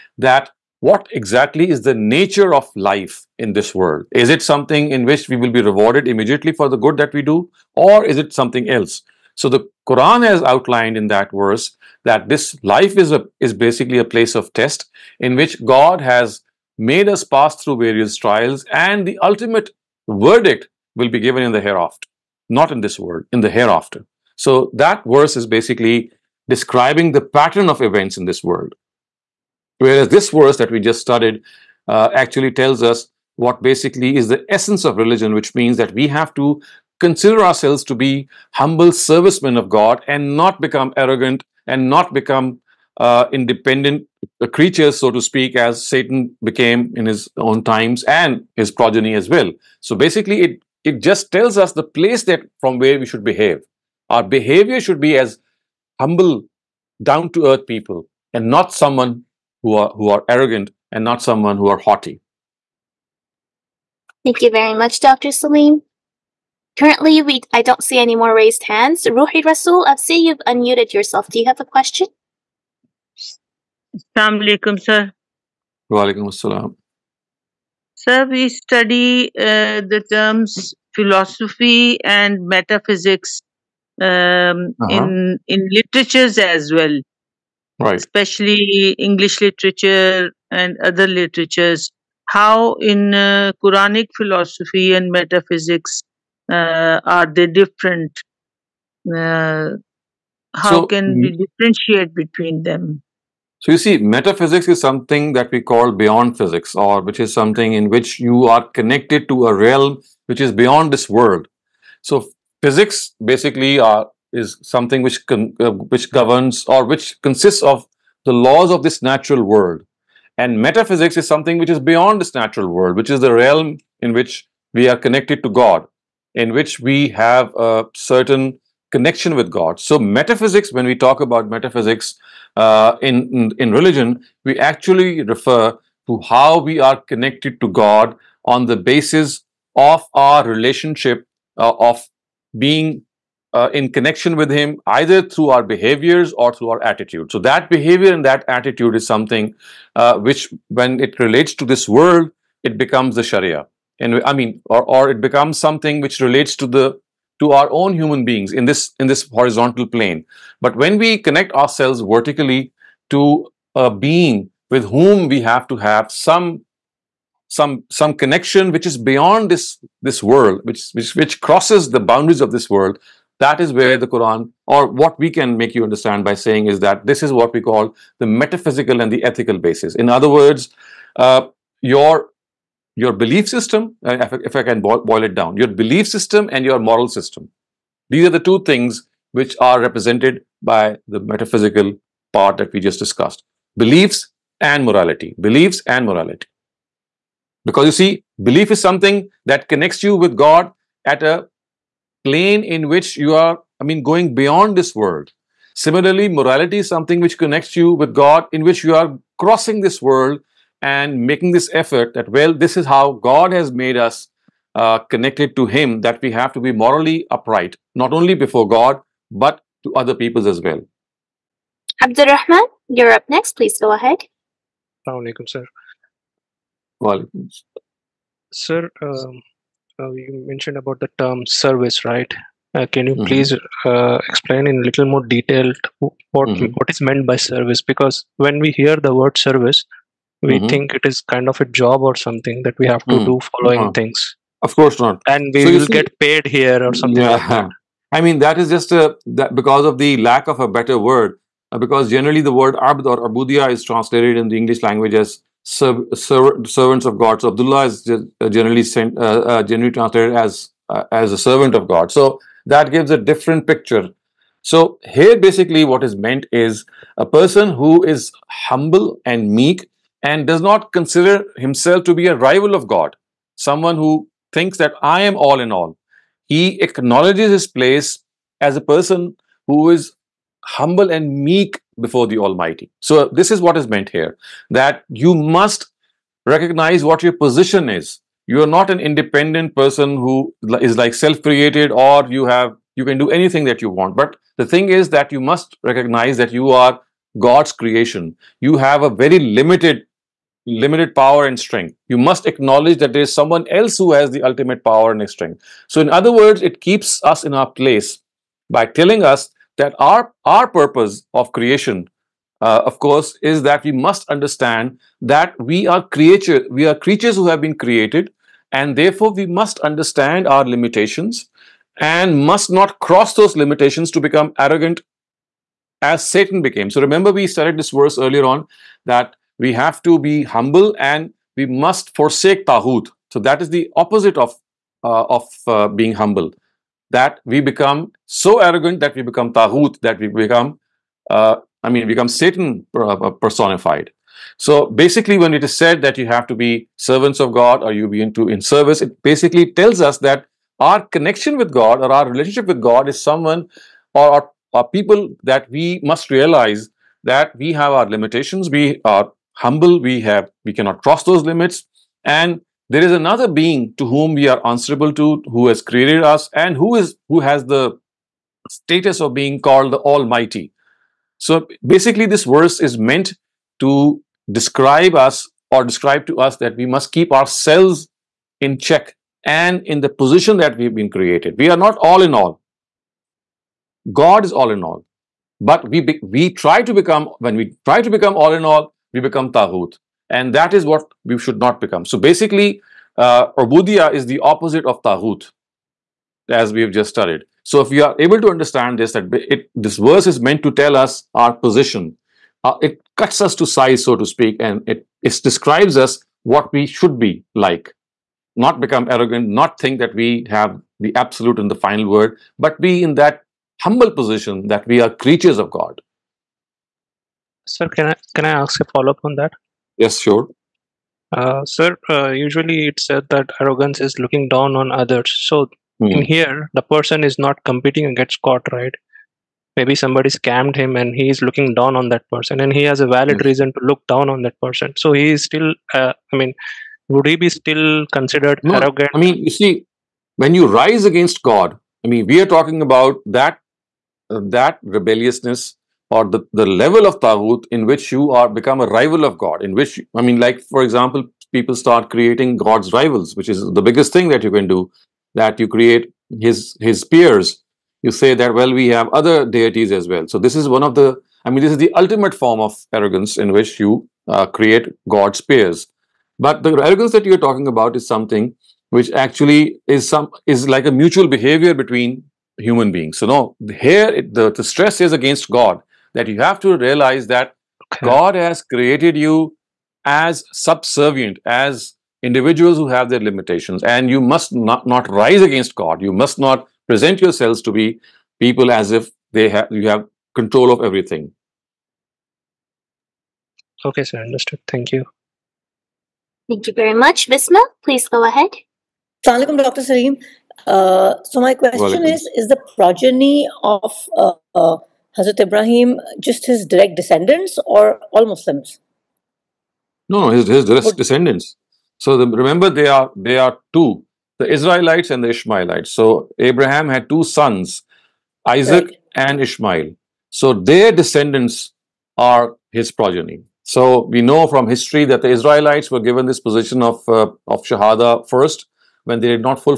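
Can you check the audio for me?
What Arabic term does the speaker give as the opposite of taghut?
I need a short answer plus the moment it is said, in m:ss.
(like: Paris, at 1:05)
Ubudiyah, at 6:33.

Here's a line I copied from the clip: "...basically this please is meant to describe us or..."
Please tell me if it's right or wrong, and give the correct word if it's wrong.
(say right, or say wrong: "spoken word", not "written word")
wrong: "verse", not "please".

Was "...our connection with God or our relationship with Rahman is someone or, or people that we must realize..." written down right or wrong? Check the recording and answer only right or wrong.
wrong.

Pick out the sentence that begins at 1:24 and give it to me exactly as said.
in in literatures as well, right?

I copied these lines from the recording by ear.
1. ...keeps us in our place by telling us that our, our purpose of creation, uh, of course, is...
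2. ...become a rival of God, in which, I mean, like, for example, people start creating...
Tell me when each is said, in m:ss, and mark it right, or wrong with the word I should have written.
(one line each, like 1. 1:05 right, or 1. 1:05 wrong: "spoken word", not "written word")
1. 5:06 right
2. 7:28 right.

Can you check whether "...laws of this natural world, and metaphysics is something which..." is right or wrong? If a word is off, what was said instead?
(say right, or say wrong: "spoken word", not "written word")
right.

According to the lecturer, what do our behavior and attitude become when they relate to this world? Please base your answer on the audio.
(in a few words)
The Sharia.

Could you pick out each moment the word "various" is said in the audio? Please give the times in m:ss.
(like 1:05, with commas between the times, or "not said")
0:17.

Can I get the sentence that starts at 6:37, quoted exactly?
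So if we are able to understand this, that it, this verse is meant to tell us our position.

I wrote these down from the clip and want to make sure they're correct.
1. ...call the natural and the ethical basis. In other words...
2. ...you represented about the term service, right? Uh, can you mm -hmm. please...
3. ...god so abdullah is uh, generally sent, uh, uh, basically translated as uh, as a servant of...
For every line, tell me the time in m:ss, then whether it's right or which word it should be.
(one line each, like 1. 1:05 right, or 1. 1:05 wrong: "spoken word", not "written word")
1. 2:57 wrong: "metaphysical", not "natural"
2. 3:50 wrong: "mentioned", not "represented"
3. 4:17 wrong: "generally", not "basically".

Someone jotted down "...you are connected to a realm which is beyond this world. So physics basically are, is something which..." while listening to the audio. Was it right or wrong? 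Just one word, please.
right.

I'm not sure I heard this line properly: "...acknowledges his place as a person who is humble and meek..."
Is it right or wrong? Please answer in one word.
right.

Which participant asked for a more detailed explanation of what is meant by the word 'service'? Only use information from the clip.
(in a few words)
Abdul Rahman.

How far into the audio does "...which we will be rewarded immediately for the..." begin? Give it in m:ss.
0:05.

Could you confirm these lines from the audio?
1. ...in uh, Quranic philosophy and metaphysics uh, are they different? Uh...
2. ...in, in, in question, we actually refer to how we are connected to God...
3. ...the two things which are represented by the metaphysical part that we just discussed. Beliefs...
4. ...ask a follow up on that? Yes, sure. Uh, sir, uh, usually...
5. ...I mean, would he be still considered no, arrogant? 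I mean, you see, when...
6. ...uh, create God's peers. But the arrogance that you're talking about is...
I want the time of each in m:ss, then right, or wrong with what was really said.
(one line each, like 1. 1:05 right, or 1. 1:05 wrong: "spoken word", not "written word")
1. 1:32 right
2. 2:13 wrong: "religion", not "question"
3. 3:08 right
4. 6:58 right
5. 7:16 right
6. 7:44 right.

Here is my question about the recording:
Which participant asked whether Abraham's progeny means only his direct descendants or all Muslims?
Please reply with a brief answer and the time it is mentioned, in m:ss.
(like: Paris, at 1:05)
Visma, at 8:17.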